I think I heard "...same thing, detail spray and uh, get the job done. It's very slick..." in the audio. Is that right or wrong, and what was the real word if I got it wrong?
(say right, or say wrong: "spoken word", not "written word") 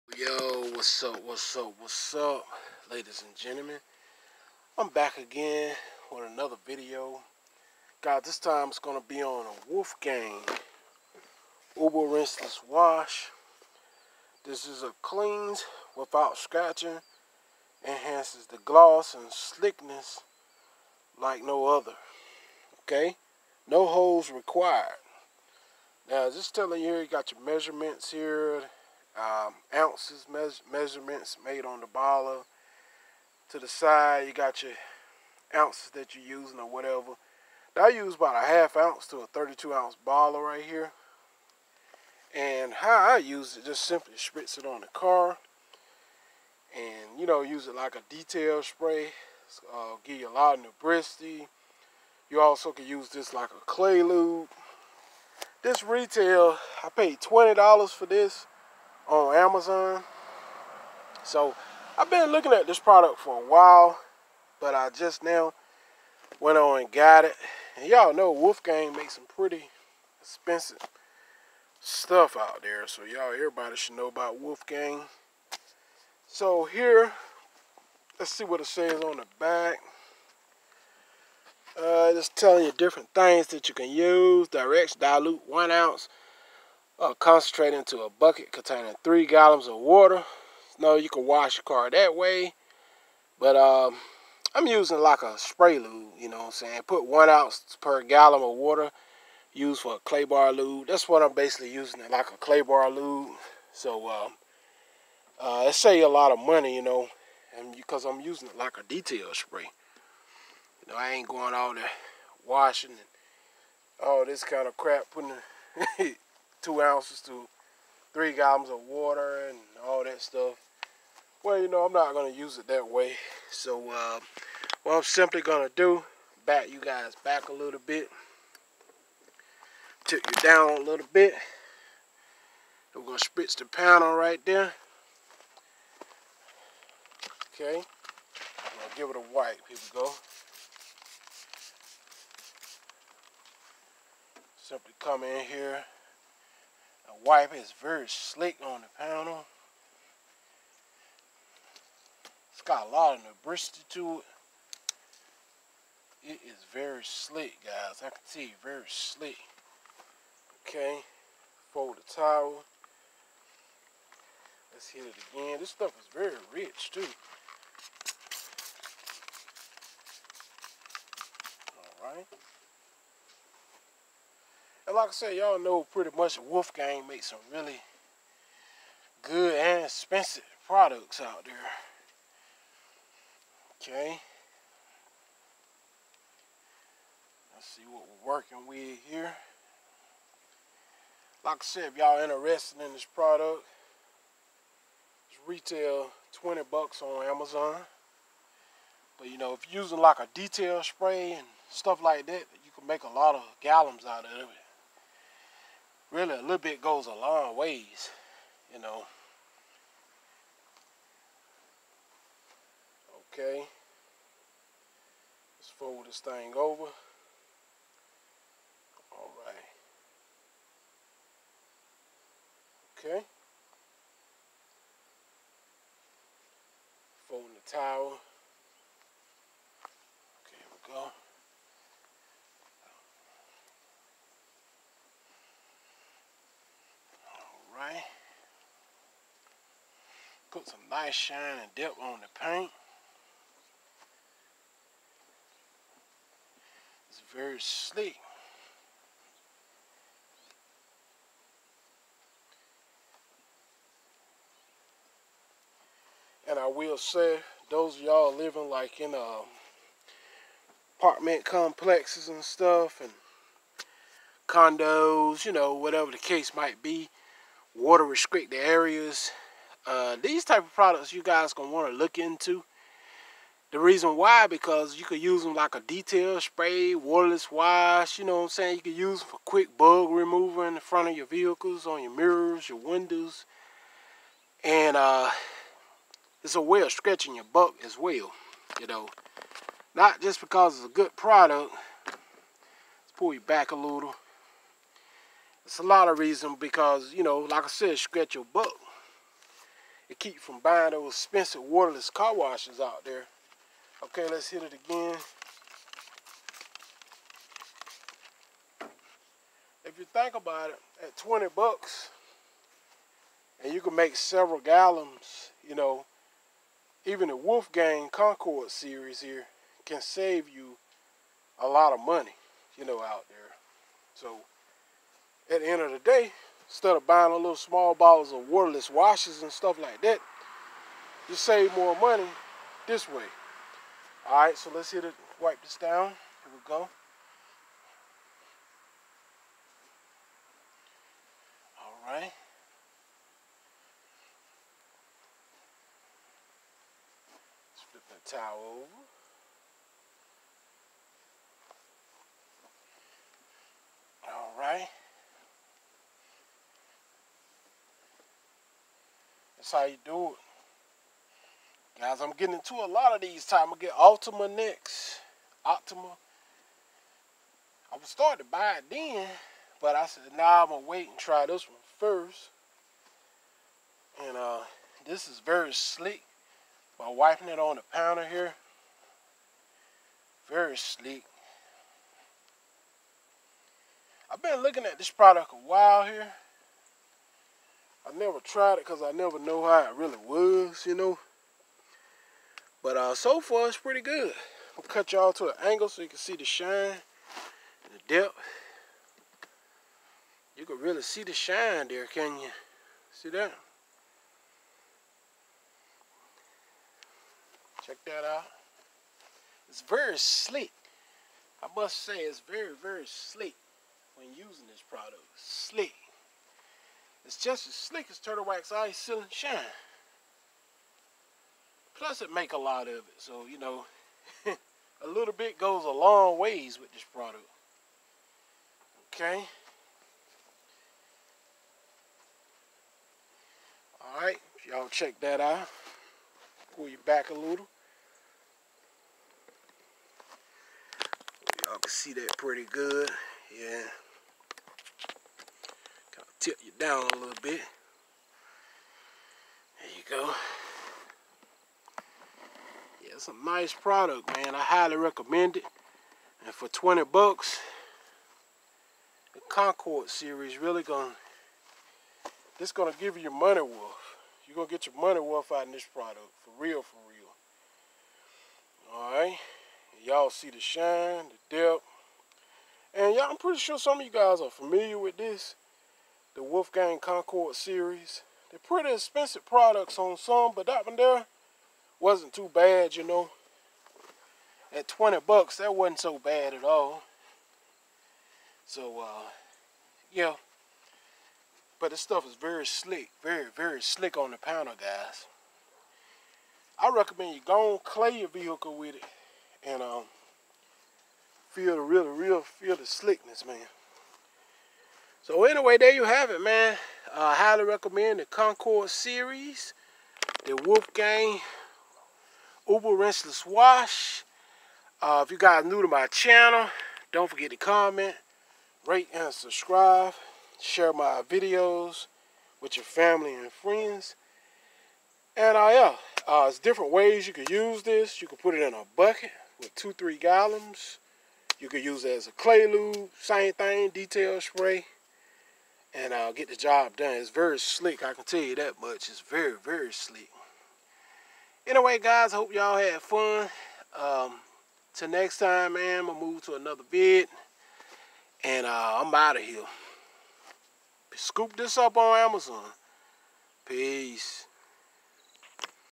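right.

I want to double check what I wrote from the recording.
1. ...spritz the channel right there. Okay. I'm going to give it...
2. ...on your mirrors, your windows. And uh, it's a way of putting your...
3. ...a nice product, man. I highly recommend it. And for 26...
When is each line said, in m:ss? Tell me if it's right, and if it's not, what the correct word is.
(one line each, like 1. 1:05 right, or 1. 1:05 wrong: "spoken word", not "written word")
1. 2:13 wrong: "panel", not "channel"
2. 4:41 wrong: "stretching", not "putting"
3. 7:33 wrong: "20", not "26".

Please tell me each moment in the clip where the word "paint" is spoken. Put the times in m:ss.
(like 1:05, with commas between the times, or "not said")
4:02.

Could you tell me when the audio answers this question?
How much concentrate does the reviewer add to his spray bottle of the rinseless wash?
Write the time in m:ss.
0:38.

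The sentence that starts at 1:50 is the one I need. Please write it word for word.
You know, I ain't going all the washing and all this kind of crap putting.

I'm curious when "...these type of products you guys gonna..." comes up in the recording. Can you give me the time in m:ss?
4:30.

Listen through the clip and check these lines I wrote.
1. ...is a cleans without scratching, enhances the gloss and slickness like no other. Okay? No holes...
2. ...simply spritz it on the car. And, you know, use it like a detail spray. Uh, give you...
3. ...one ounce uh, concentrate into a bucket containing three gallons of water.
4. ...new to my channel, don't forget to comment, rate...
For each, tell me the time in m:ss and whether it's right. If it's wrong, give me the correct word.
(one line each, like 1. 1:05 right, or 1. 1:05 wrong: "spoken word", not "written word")
1. 0:14 right
2. 0:43 right
3. 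1:25 right
4. 8:35 right.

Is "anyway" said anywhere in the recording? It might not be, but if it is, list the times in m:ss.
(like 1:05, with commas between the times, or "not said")
8:25, 9:01.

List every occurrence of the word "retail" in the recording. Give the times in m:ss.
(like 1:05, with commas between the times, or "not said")
0:55, 3:15.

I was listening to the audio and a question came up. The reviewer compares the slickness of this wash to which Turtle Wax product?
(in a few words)
Ice Seal N Shine.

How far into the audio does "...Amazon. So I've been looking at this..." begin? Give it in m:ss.
0:59.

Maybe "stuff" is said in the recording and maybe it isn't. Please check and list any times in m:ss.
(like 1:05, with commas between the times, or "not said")
1:11, 2:00, 2:45, 3:21, 4:22, 5:29, 8:12.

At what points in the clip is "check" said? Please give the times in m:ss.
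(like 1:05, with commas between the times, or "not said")
6:47, 7:14.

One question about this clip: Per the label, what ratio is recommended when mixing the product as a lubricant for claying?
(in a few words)
1 ounce per gallon.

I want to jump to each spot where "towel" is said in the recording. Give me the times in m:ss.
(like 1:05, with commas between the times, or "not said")
2:42, 3:47, 5:48.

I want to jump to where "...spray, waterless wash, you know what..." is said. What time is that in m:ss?
4:36.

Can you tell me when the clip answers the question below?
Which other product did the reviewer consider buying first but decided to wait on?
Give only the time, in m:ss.
6:05.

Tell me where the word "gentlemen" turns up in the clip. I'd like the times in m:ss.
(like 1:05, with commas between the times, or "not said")
0:03.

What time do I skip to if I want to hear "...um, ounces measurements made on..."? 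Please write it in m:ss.
0:29.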